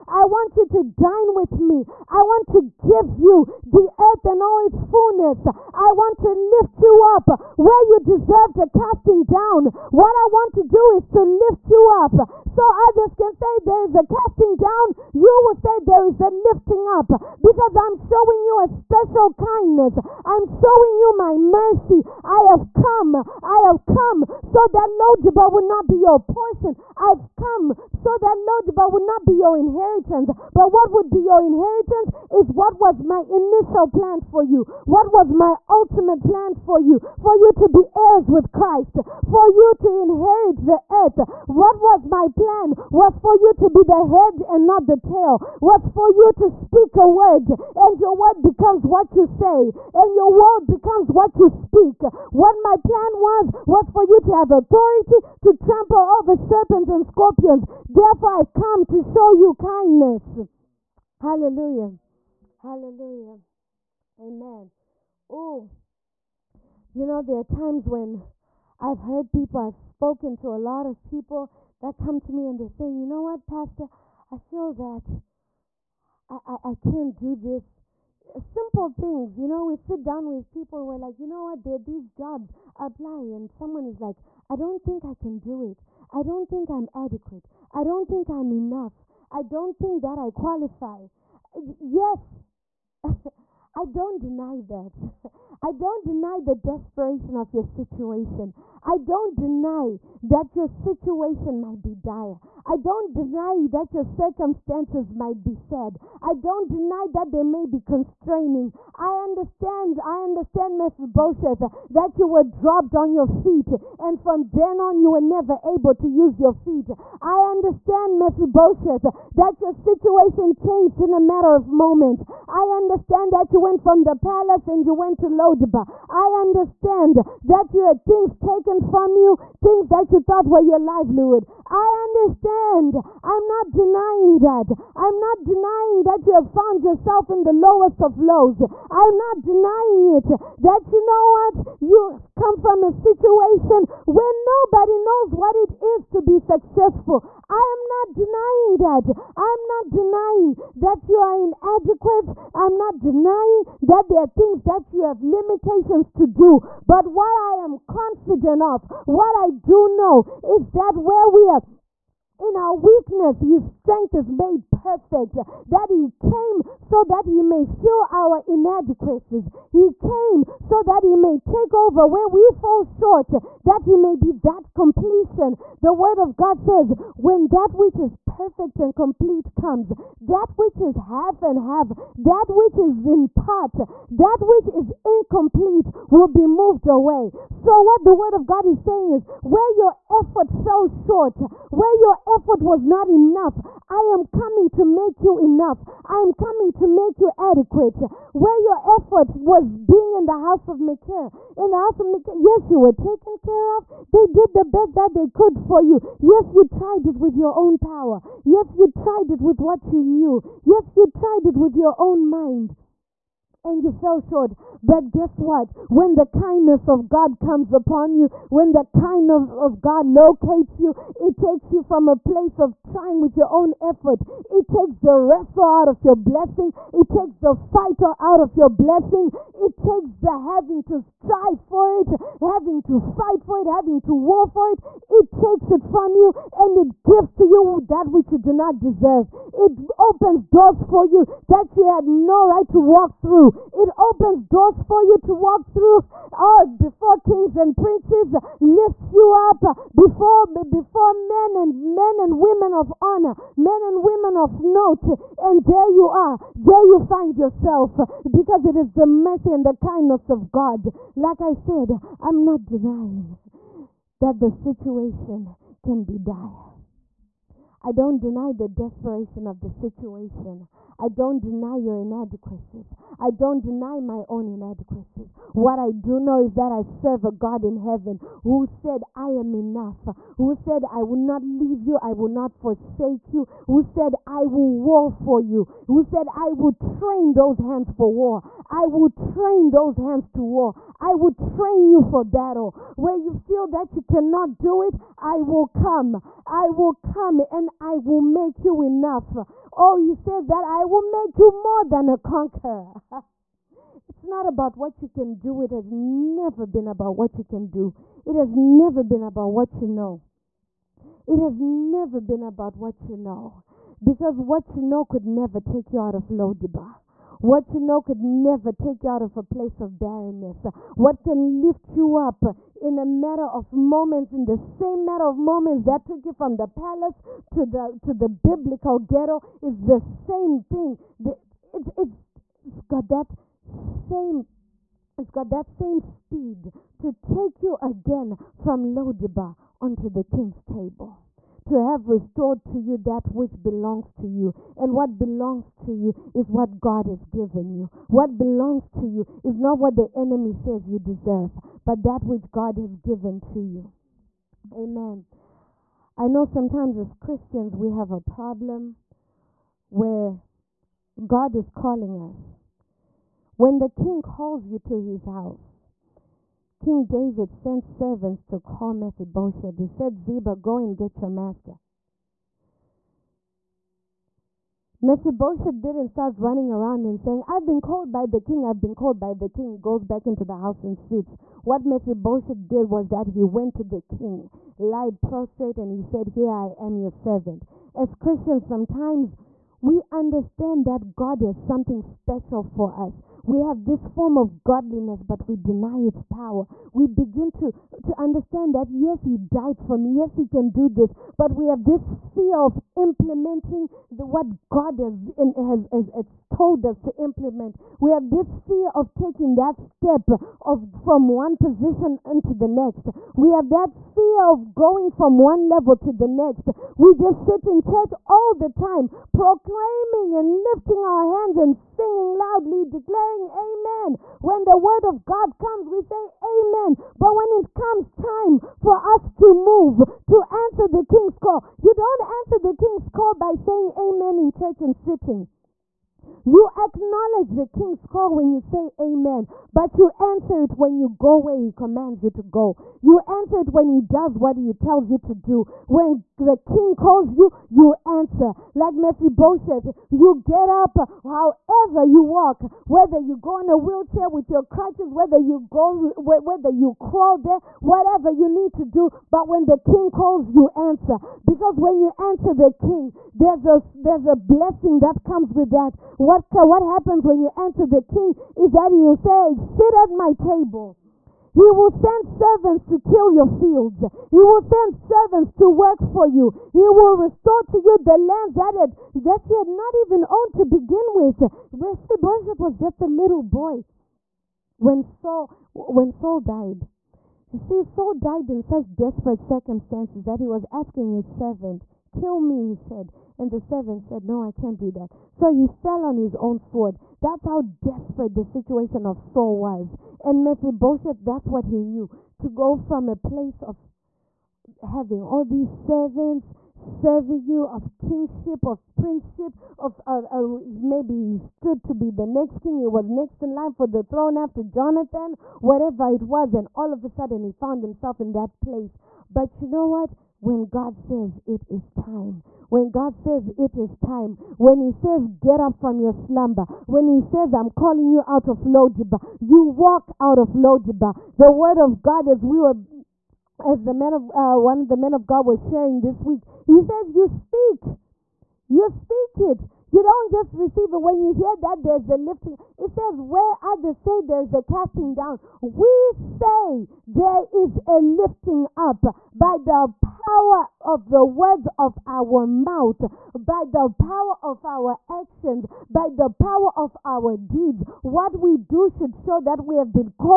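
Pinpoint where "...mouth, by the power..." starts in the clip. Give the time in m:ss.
9:12.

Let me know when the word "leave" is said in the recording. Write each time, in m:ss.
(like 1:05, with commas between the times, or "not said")
4:41.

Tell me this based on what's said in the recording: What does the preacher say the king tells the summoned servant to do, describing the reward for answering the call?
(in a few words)
Sit at my table.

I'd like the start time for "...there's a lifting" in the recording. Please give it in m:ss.
9:01.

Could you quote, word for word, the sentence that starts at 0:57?
Therefore, I've come to show show you kindness.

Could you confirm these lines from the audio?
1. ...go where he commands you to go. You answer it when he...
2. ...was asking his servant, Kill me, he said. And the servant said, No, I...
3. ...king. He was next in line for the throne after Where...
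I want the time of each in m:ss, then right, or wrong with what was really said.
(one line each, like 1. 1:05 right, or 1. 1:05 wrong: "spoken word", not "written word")
1. 7:21 right
2. 8:10 right
3. 8:32 wrong: "Jonathan", not "Where".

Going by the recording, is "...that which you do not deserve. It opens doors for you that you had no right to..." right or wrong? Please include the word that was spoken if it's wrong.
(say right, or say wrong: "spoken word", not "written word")
right.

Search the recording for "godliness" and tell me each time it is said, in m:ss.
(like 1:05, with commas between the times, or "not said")
6:34.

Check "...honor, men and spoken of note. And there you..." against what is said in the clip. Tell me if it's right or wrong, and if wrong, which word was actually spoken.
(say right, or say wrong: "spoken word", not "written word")
wrong: "women", not "spoken".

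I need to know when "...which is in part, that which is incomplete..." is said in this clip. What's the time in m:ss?
3:02.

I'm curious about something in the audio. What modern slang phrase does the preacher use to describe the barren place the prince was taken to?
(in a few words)
Biblical ghetto.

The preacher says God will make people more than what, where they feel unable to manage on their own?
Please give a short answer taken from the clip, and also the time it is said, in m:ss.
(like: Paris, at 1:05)
A conqueror, at 5:01.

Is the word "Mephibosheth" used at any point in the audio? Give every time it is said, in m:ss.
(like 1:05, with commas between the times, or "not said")
1:50, 1:58, 6:08, 6:15, 6:21, 7:28, 8:01, 8:20.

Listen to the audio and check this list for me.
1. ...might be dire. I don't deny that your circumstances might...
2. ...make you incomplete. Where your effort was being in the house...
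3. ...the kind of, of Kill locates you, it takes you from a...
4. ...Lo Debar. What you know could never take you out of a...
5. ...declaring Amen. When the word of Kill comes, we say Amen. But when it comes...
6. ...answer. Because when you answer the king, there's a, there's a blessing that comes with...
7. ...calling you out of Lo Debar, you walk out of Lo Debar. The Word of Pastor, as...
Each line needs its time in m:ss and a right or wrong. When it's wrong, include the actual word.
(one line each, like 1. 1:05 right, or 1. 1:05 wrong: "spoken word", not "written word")
1. 1:41 right
2. 3:16 wrong: "adequate", not "incomplete"
3. 3:38 wrong: "God", not "Kill"
4. 5:16 right
5. 7:02 wrong: "God", not "Kill"
6. 7:40 right
7. 8:47 wrong: "God", not "Pastor".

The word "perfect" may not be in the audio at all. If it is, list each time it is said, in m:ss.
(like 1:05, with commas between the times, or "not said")
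2:44, 2:58.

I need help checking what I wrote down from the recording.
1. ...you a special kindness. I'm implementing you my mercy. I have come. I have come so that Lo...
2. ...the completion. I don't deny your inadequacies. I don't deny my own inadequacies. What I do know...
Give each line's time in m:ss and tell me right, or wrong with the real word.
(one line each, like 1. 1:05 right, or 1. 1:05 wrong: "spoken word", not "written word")
1. 0:18 wrong: "showing", not "implementing"
2. 4:29 wrong: "situation", not "completion".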